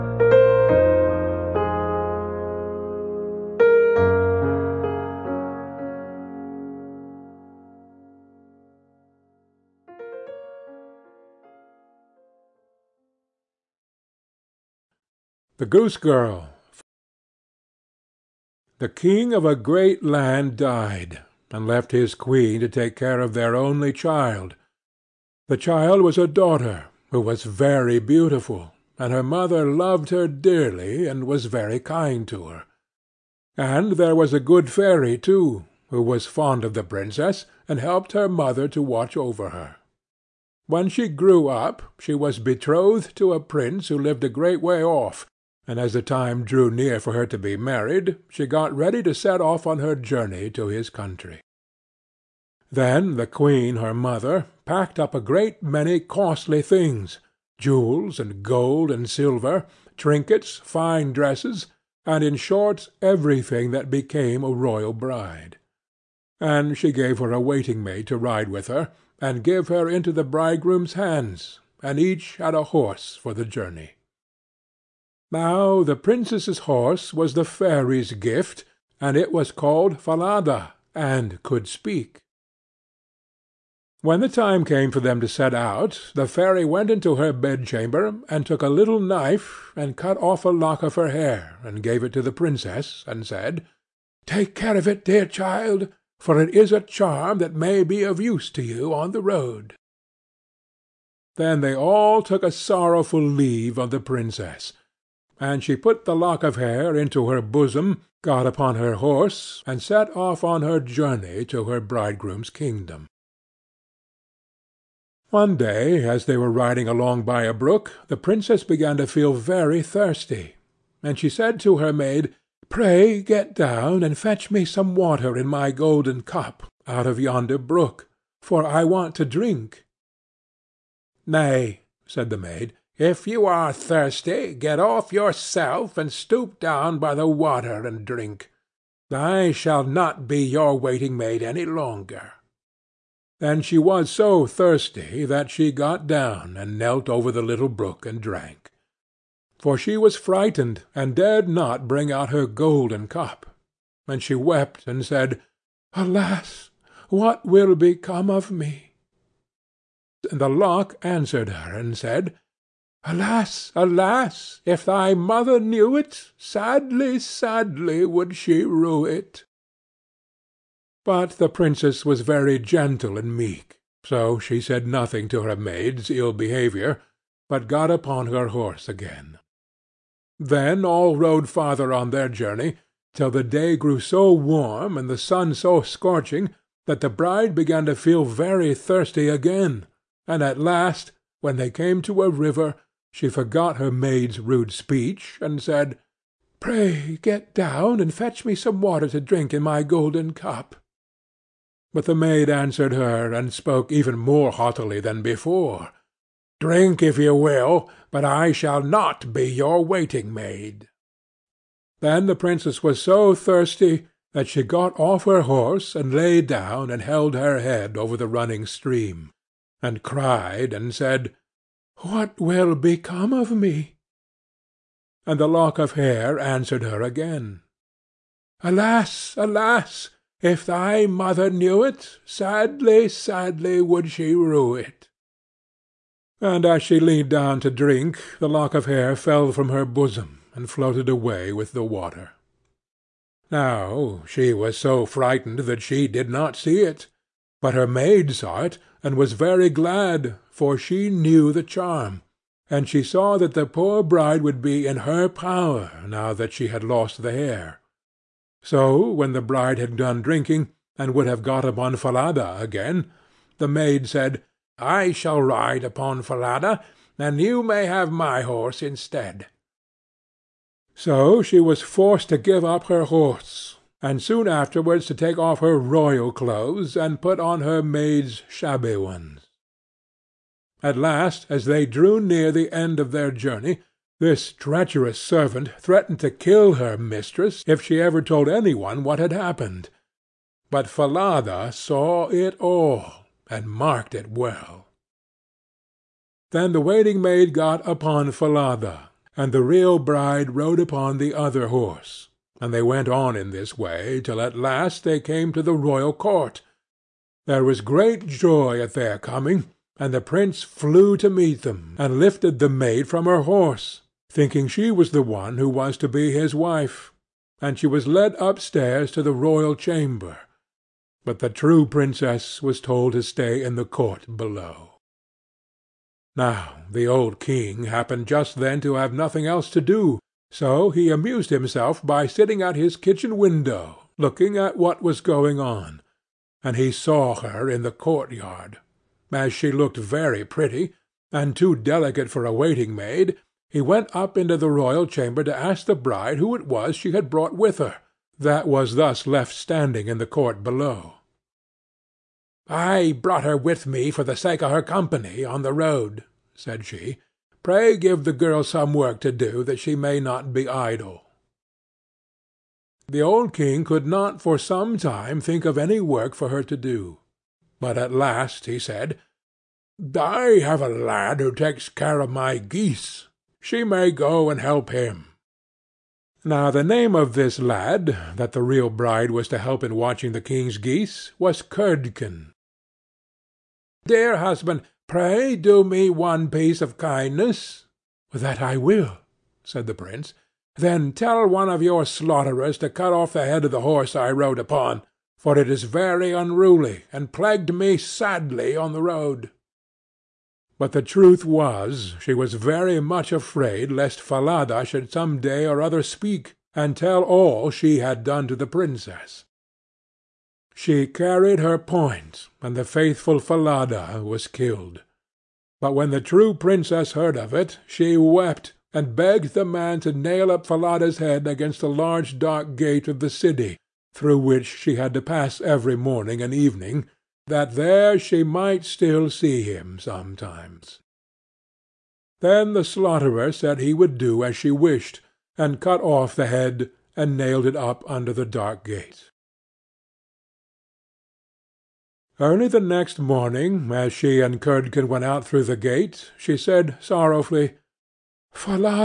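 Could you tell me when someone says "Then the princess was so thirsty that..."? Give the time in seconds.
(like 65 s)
211 s.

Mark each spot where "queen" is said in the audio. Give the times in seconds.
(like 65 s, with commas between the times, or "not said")
22 s, 53 s.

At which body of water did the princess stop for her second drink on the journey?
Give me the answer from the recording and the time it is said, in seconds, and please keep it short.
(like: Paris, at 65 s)
A river, at 191 s.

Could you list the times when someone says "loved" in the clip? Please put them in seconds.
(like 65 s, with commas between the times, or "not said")
29 s.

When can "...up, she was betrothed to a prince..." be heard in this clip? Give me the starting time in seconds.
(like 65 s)
41 s.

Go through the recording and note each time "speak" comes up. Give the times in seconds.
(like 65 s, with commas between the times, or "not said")
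81 s, 406 s.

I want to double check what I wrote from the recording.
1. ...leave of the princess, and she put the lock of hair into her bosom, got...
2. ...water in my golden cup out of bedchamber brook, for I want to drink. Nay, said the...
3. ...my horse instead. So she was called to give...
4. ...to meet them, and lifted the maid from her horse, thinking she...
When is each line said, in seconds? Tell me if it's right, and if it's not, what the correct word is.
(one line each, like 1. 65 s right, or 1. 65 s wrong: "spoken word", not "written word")
1. 103 s right
2. 124 s wrong: "yonder", not "bedchamber"
3. 268 s wrong: "forced", not "called"
4. 311 s right.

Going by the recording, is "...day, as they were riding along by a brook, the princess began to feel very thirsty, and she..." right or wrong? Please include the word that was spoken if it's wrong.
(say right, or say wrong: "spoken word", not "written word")
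right.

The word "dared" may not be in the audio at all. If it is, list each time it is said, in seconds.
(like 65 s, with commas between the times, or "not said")
151 s.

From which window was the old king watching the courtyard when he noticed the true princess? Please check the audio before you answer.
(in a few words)
His kitchen window.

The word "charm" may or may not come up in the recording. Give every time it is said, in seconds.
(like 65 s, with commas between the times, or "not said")
96 s, 251 s.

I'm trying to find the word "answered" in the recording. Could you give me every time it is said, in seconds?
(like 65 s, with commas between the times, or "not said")
161 s, 202 s, 226 s.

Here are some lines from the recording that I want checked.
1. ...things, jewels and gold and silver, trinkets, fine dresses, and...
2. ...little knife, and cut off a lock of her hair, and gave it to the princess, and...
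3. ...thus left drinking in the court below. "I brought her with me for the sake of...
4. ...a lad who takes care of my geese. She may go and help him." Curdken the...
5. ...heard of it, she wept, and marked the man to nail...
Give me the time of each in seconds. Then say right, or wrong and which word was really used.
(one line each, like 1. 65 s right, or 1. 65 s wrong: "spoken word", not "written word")
1. 56 s right
2. 88 s right
3. 348 s wrong: "standing", not "drinking"
4. 370 s wrong: "Now", not "Curdken"
5. 417 s wrong: "begged", not "marked".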